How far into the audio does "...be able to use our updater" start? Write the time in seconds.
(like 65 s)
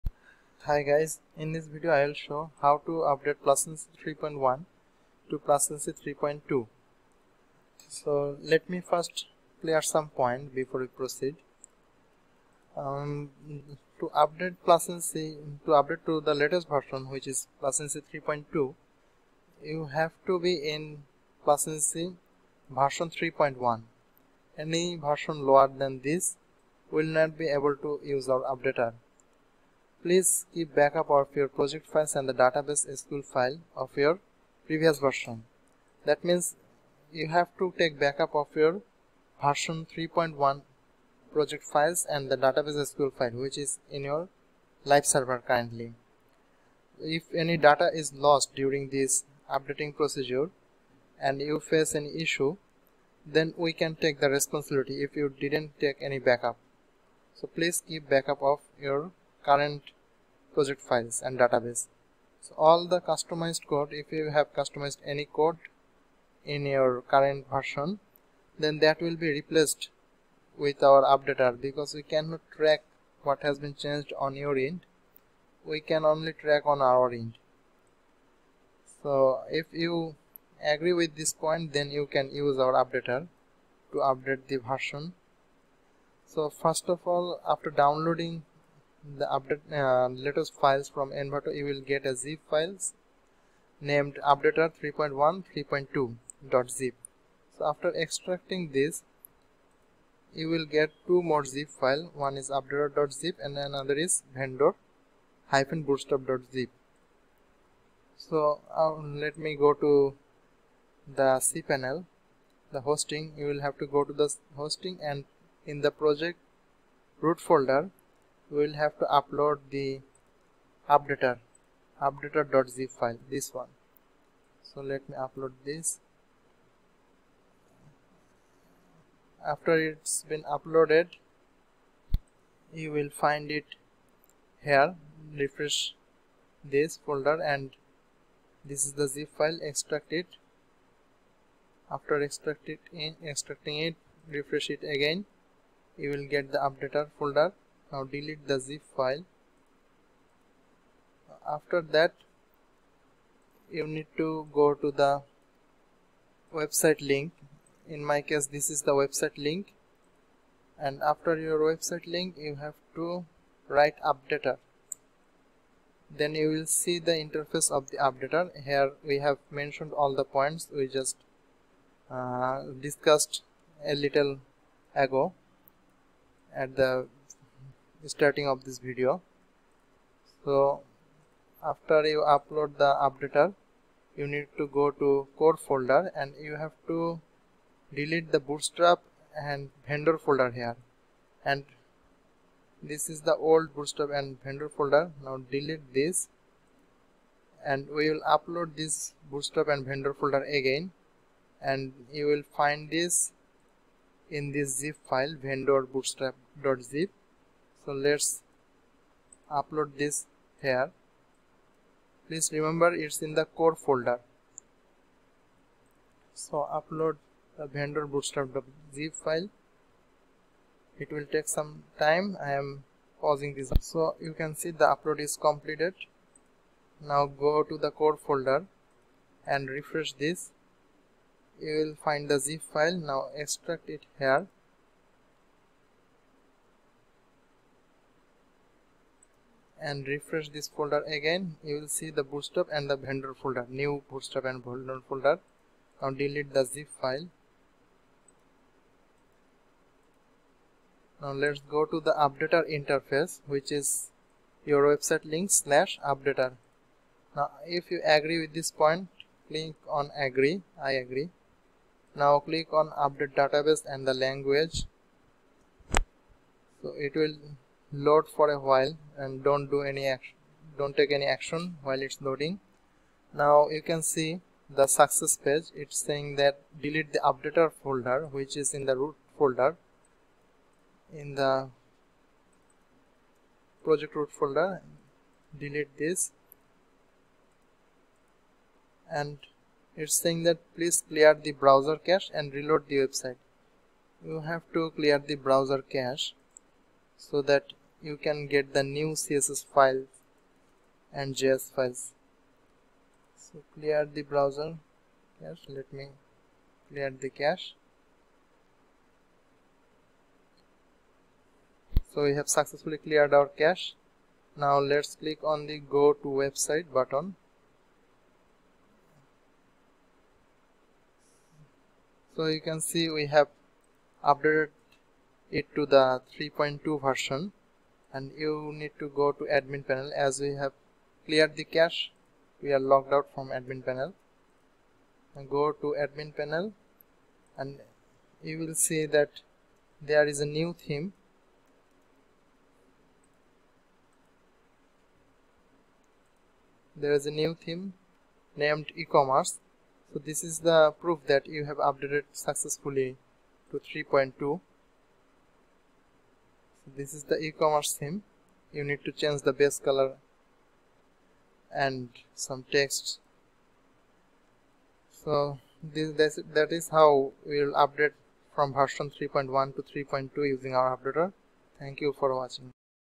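27 s.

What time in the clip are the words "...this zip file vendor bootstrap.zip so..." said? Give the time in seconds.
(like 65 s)
204 s.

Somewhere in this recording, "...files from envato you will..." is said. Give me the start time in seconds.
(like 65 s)
90 s.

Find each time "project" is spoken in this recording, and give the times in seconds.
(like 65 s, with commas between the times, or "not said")
31 s, 41 s, 60 s, 115 s, 283 s.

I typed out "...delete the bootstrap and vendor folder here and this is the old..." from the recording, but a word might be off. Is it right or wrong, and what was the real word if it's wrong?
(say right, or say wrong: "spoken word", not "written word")
right.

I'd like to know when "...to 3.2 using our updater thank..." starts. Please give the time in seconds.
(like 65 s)
369 s.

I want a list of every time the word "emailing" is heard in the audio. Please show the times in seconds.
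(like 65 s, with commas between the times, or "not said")
not said.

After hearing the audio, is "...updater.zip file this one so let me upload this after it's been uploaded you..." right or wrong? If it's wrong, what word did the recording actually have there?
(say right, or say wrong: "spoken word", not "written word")
right.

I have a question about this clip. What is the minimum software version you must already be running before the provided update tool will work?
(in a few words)
PlusAgency 3.1.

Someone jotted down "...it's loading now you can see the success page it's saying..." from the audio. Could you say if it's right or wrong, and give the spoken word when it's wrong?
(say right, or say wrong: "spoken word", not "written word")
right.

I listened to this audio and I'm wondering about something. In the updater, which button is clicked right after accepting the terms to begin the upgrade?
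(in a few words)
Update database and the language.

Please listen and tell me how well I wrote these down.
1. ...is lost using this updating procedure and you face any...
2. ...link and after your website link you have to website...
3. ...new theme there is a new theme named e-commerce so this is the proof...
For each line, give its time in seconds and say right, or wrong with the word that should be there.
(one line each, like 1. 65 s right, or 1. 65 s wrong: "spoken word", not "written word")
1. 47 s wrong: "during", not "using"
2. 159 s wrong: "write", not "website"
3. 340 s right.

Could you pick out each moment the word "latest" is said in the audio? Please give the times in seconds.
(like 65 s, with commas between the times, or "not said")
16 s, 90 s.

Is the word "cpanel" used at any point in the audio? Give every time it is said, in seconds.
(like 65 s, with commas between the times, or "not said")
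111 s.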